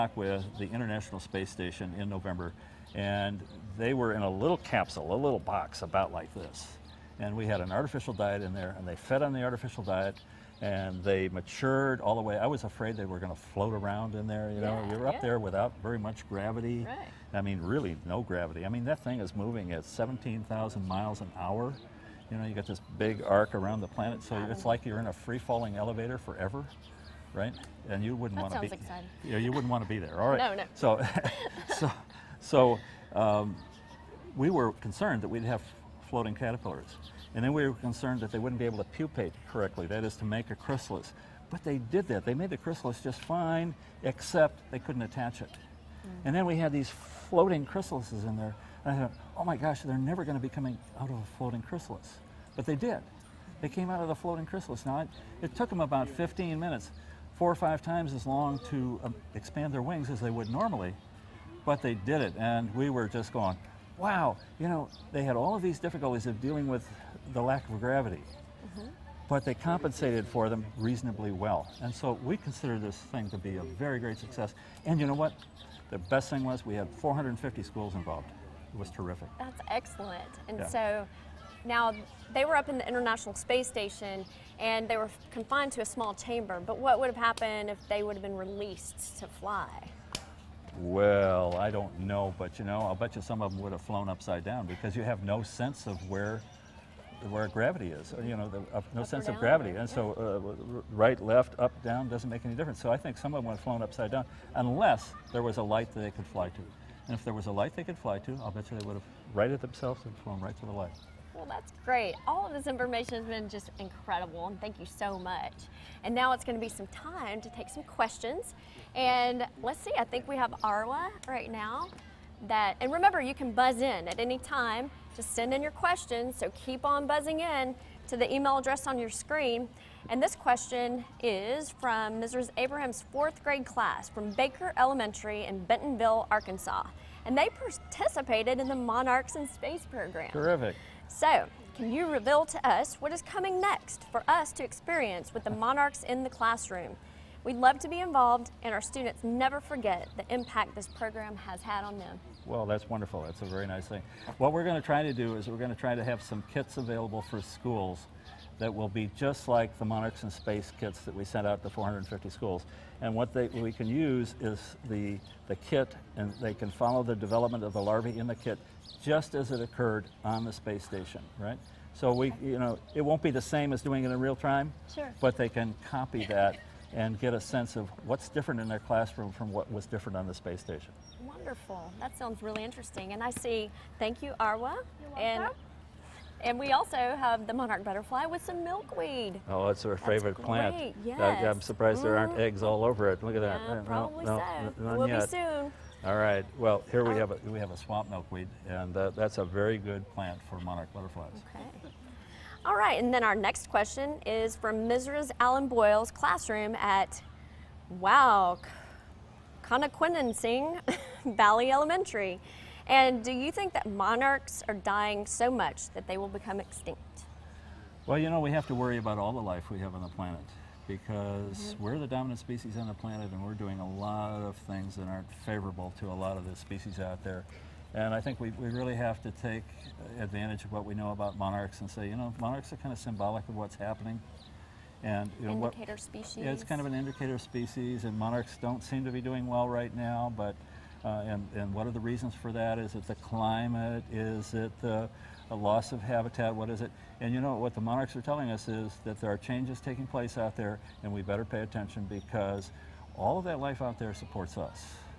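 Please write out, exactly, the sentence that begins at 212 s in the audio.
And do you think that monarchs are dying so much that they will become extinct?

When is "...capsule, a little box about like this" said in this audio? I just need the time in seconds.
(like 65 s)
4 s.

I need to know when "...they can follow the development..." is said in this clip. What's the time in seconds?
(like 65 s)
166 s.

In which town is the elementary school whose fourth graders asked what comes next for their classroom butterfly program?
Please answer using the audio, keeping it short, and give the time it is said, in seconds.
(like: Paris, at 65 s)
Bentonville, Arkansas, at 135 s.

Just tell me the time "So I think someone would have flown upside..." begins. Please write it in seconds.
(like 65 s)
102 s.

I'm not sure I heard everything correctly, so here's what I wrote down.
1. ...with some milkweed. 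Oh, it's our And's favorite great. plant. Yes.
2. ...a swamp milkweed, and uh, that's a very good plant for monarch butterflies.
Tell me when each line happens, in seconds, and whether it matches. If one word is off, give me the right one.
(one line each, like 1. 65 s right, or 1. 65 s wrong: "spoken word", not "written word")
1. 188 s wrong: "That", not "And"
2. 197 s right.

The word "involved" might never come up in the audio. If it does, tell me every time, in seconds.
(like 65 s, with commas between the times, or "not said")
77 s, 148 s.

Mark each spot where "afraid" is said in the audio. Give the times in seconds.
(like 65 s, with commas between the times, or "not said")
12 s.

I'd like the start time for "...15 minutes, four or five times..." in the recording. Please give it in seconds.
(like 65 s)
56 s.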